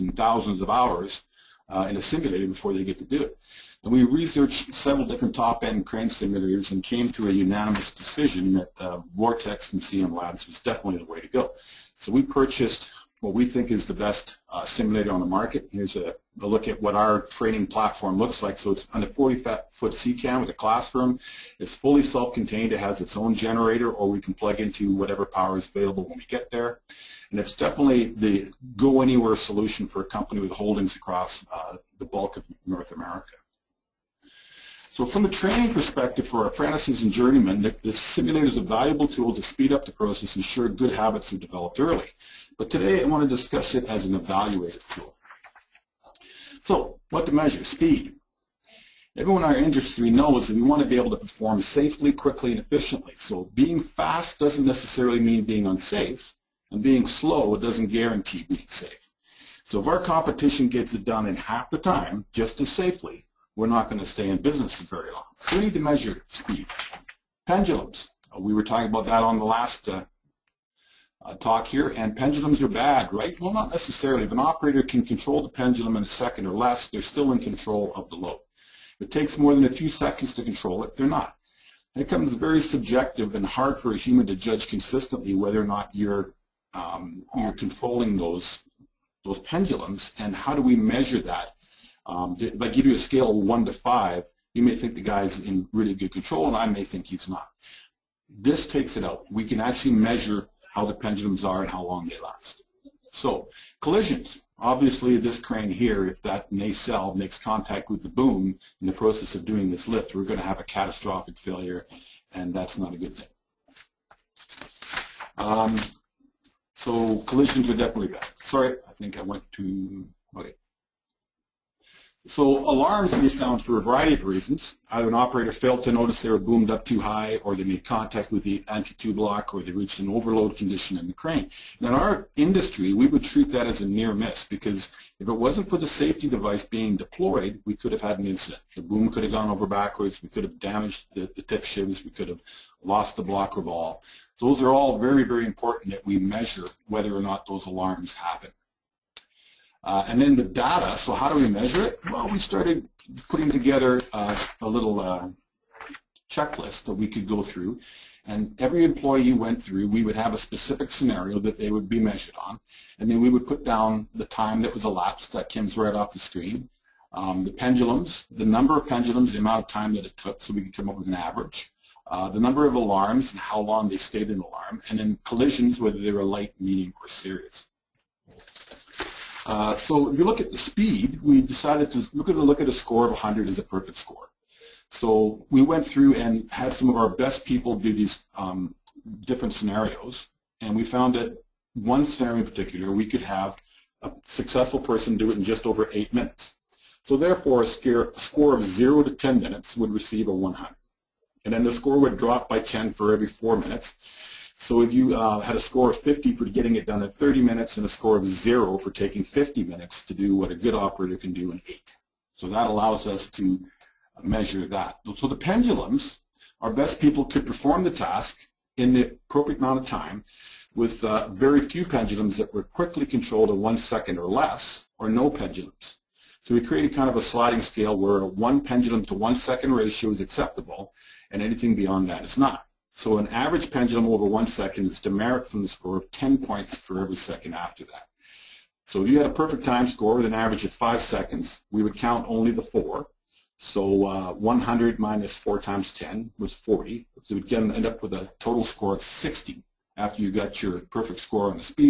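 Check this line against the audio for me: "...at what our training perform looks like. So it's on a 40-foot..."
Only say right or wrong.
wrong.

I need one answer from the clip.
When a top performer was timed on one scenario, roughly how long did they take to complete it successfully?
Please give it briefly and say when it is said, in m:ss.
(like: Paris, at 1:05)
just over 8 minutes, at 3:15.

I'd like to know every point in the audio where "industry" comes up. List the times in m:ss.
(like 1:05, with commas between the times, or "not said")
0:49, 2:12.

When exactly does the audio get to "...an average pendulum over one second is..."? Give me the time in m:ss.
3:53.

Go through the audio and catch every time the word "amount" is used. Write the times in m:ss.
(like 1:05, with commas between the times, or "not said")
2:49, 3:39.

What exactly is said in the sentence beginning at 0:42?
But today I want to discuss it as an evaluative tool.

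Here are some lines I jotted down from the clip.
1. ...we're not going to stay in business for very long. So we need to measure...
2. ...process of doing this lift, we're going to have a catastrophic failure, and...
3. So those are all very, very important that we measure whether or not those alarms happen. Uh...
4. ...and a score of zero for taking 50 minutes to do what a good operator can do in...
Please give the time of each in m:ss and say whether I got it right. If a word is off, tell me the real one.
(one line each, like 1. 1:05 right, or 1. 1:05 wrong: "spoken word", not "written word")
1. 1:03 right
2. 1:48 right
3. 2:24 right
4. 3:27 right.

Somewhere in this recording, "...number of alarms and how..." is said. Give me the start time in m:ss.
2:52.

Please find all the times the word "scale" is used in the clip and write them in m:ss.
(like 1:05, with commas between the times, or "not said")
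1:32, 3:47.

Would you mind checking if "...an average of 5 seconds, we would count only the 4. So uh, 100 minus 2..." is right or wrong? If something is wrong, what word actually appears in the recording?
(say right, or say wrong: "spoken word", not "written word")
wrong: "4", not "2".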